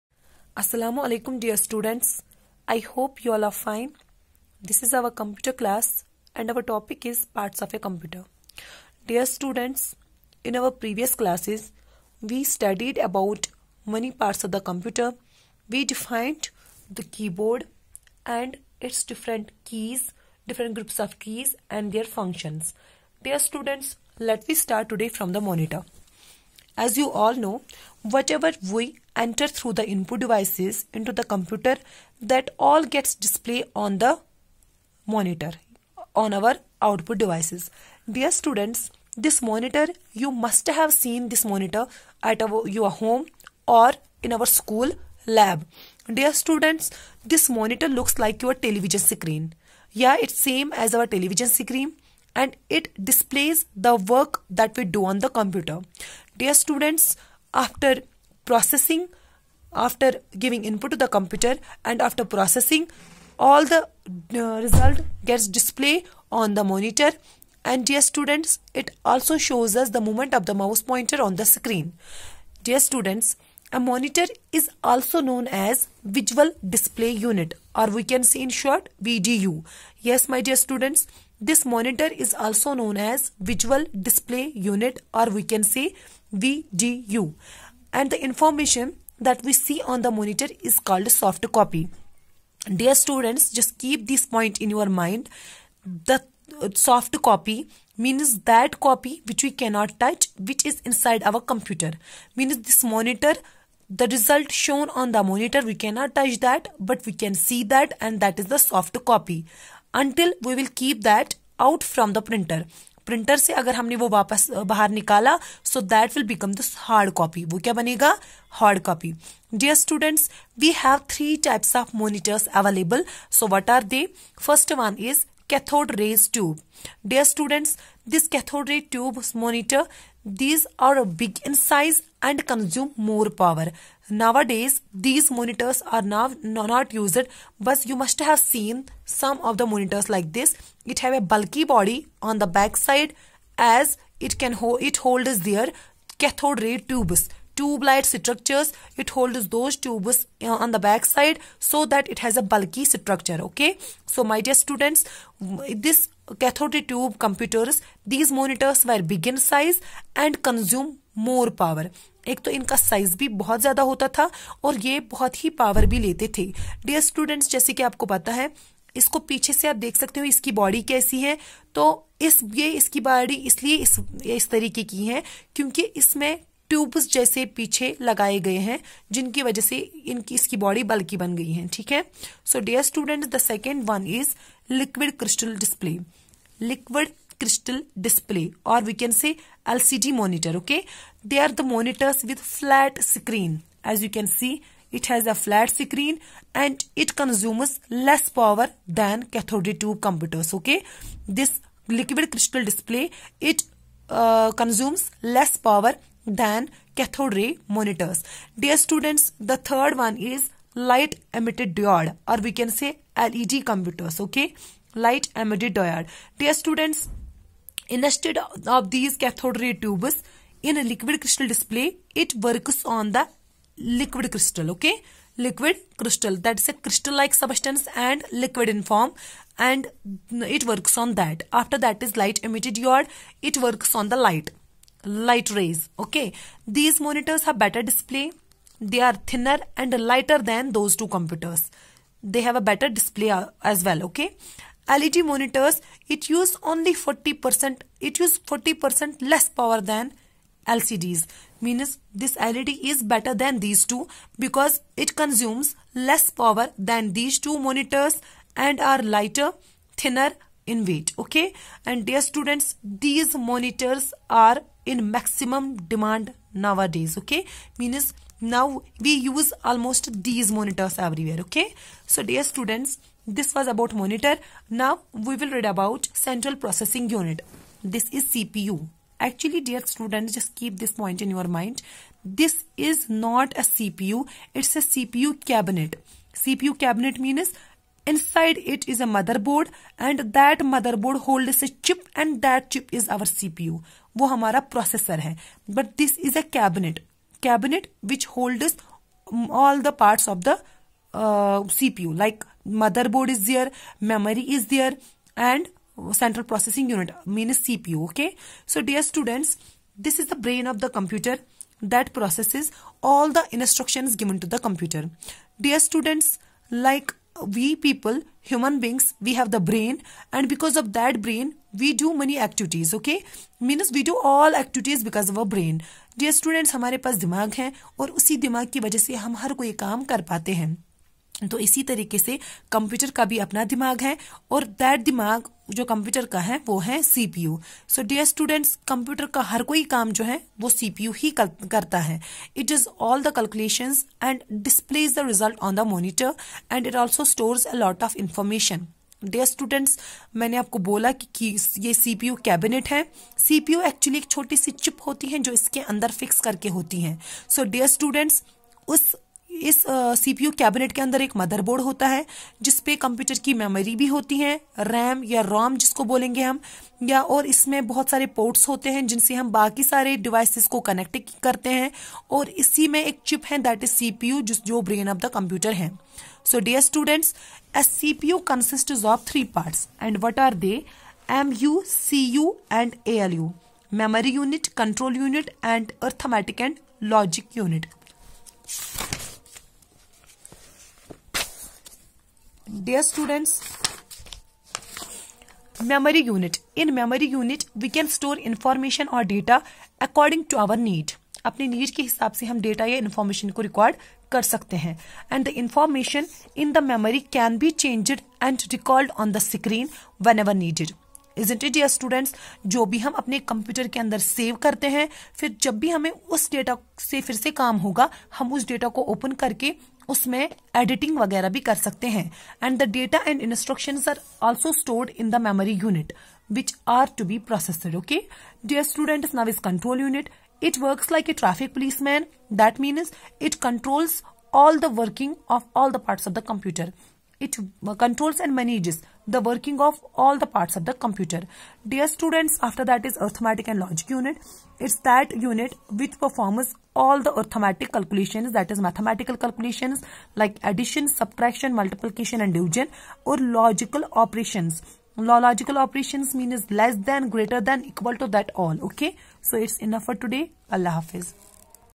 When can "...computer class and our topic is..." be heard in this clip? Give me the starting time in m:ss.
0:05.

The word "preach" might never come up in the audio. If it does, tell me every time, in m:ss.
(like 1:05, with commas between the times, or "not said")
not said.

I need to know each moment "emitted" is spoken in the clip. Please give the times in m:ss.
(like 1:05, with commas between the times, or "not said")
3:31, 3:35, 3:52.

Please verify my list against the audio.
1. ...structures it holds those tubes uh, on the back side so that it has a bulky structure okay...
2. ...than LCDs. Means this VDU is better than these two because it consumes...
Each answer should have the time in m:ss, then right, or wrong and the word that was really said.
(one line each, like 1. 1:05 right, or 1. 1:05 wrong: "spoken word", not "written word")
1. 2:28 right
2. 4:09 wrong: "LED", not "VDU".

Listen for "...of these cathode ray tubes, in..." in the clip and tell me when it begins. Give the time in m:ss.
3:38.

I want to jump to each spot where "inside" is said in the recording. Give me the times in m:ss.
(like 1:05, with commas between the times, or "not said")
1:40, 4:48.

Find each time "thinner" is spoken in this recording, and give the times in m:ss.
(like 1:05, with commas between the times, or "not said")
3:59, 4:19.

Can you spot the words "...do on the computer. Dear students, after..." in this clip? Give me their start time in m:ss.
0:54.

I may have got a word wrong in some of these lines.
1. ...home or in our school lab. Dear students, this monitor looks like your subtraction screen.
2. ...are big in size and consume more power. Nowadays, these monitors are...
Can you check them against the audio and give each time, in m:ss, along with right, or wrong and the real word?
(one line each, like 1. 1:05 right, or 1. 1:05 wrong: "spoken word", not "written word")
1. 0:42 wrong: "television", not "subtraction"
2. 2:10 right.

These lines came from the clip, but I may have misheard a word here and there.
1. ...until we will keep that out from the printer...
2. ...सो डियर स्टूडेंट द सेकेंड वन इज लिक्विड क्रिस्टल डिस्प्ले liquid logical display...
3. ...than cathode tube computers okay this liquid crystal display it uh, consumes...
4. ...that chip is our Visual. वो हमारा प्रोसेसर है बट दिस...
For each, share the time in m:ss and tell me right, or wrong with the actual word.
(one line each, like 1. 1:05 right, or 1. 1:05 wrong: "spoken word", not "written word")
1. 1:49 right
2. 3:02 wrong: "crystal", not "logical"
3. 3:19 right
4. 4:52 wrong: "CPU", not "Visual".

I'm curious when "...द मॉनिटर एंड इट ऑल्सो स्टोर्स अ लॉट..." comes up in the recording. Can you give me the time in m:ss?
5:45.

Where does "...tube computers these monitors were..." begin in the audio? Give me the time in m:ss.
2:36.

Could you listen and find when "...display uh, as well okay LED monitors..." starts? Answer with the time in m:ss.
4:02.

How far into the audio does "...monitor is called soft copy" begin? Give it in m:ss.
1:30.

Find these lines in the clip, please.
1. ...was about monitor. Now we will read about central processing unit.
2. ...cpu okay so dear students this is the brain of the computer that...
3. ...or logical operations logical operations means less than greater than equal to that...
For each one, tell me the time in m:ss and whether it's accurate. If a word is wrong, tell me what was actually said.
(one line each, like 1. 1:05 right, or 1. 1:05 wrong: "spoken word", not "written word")
1. 4:33 right
2. 5:07 right
3. 7:33 right.